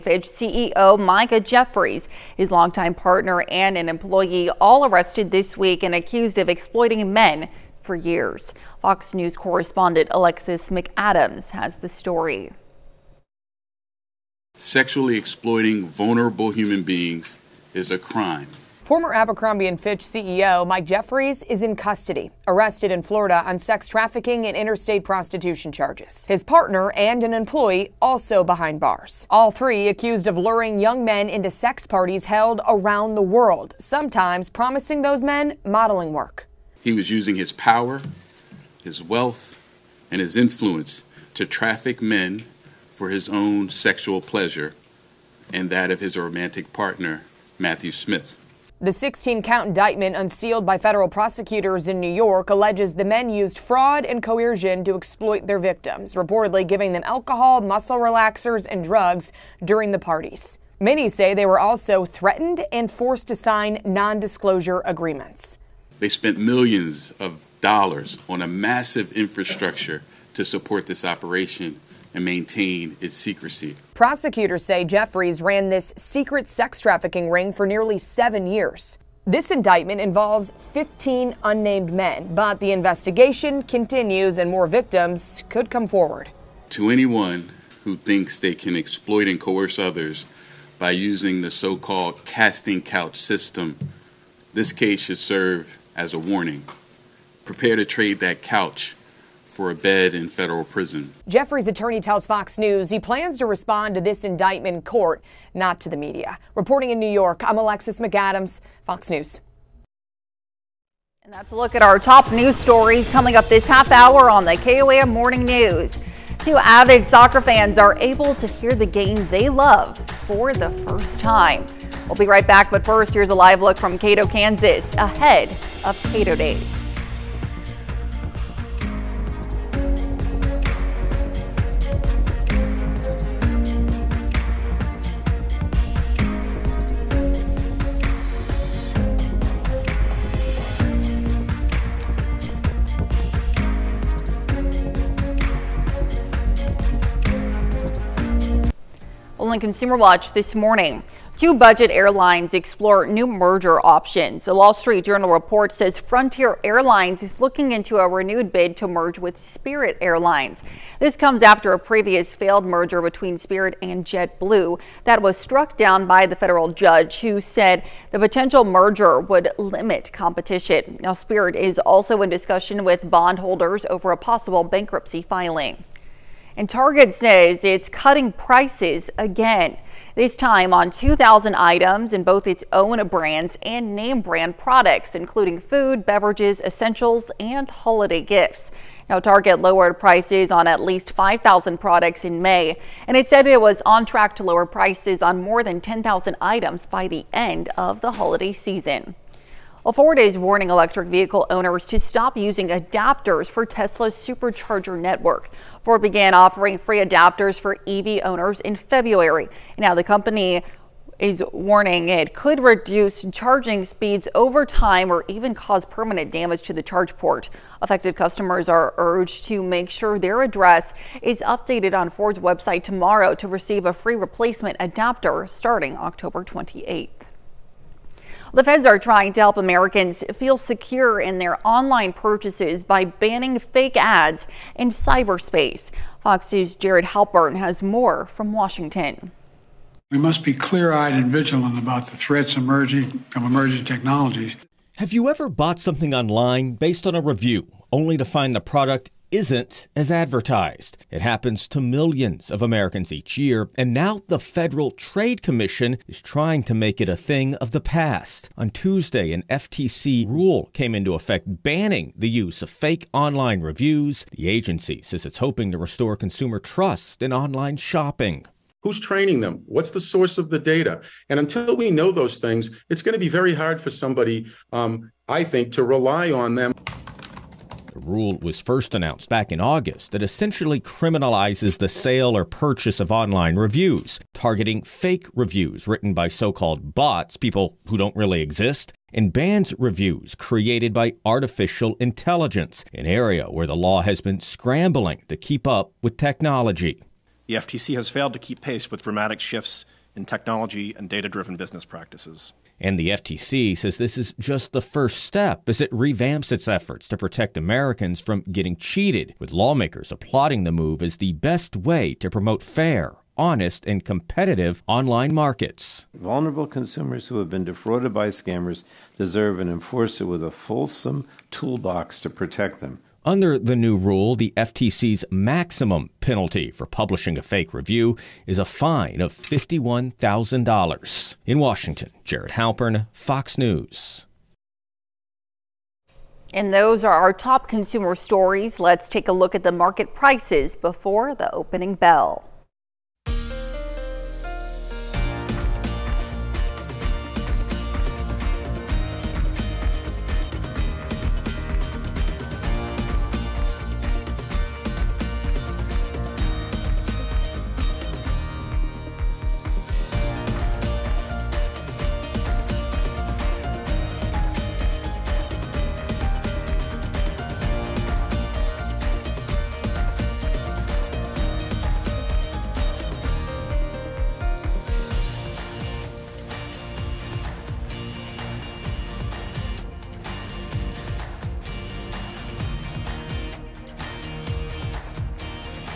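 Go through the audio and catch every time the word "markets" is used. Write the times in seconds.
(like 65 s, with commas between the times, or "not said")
315 s, 339 s.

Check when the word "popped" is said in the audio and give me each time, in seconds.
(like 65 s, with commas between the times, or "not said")
not said.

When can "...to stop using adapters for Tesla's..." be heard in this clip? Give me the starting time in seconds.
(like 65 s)
201 s.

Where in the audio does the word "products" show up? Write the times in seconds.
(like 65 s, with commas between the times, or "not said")
184 s, 191 s, 248 s.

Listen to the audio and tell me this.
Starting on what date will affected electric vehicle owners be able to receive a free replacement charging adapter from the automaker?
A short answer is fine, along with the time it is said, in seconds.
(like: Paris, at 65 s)
October 28th, at 225 s.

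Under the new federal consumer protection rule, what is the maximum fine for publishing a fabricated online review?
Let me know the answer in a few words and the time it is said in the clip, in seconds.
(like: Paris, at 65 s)
$51,000, at 329 s.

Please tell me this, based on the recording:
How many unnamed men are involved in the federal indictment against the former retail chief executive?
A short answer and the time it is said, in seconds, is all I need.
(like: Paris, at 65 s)
15, at 80 s.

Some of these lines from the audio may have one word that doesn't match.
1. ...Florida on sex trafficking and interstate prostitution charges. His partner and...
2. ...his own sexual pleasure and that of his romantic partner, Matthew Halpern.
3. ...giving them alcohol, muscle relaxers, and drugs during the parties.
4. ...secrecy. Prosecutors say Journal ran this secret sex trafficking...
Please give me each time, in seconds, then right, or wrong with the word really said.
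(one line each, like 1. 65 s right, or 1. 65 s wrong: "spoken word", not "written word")
1. 23 s right
2. 43 s wrong: "Smith", not "Halpern"
3. 56 s right
4. 73 s wrong: "Jeffries", not "Journal".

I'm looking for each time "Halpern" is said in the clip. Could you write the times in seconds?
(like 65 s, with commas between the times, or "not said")
237 s, 332 s.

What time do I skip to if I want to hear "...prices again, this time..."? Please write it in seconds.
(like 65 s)
178 s.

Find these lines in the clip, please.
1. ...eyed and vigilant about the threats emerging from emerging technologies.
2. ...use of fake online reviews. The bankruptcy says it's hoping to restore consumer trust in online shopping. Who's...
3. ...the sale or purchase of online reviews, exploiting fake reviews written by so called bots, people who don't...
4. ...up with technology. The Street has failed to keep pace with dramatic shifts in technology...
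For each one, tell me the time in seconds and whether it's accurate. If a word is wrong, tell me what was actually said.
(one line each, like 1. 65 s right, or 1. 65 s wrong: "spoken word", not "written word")
1. 240 s right
2. 262 s wrong: "agency", not "bankruptcy"
3. 281 s wrong: "targeting", not "exploiting"
4. 295 s wrong: "FTC", not "Street".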